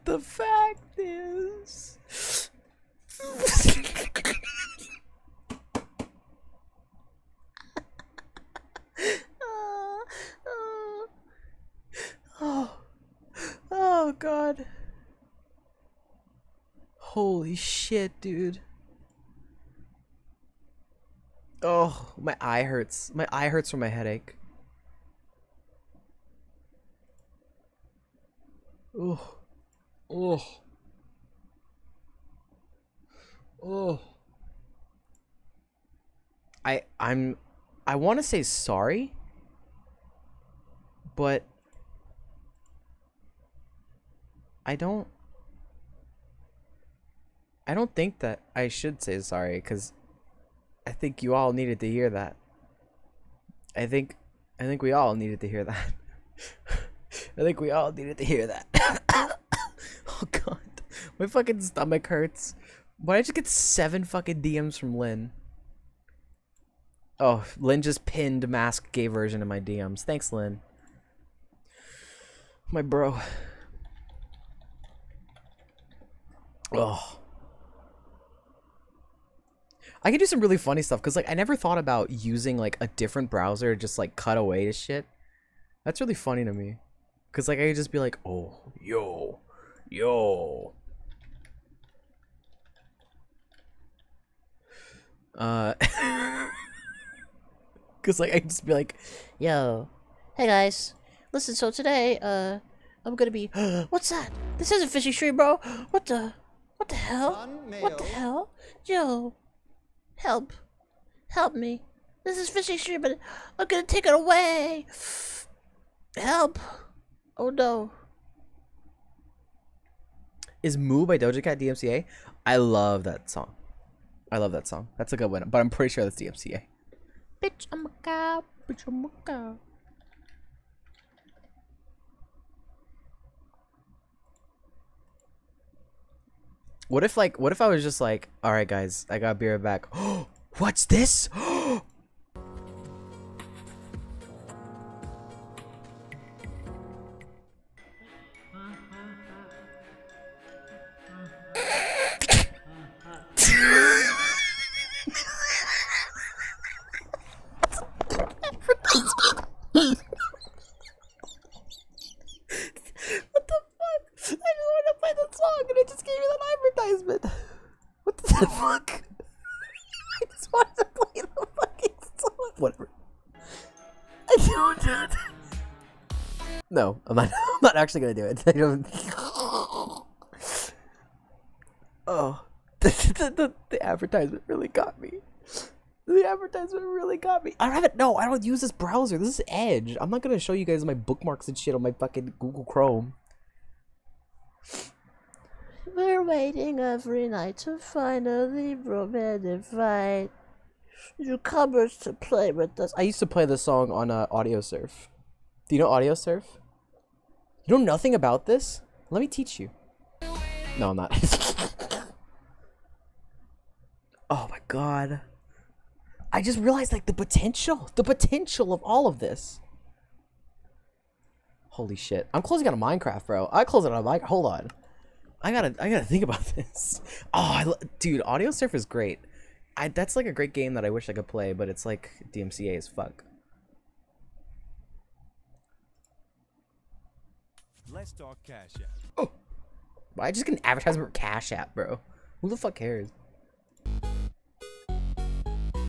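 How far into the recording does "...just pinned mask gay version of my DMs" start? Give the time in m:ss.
1:07.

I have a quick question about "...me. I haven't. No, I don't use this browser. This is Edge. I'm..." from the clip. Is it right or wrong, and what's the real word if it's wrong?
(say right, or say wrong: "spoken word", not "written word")
right.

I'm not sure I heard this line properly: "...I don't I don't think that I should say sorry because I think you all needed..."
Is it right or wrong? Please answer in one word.
right.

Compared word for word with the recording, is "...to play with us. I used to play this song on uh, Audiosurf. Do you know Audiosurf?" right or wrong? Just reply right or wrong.
right.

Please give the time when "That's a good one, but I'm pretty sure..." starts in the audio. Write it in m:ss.
2:04.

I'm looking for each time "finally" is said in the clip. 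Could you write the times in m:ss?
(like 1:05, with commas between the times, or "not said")
3:17.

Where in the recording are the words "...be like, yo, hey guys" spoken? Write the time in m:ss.
1:38.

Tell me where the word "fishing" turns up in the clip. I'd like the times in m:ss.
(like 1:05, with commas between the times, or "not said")
1:44, 1:52.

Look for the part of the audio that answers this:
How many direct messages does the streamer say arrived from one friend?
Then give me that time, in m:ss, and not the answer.
1:03.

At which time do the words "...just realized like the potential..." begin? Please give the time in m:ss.
3:36.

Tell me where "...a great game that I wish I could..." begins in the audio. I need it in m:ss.
3:50.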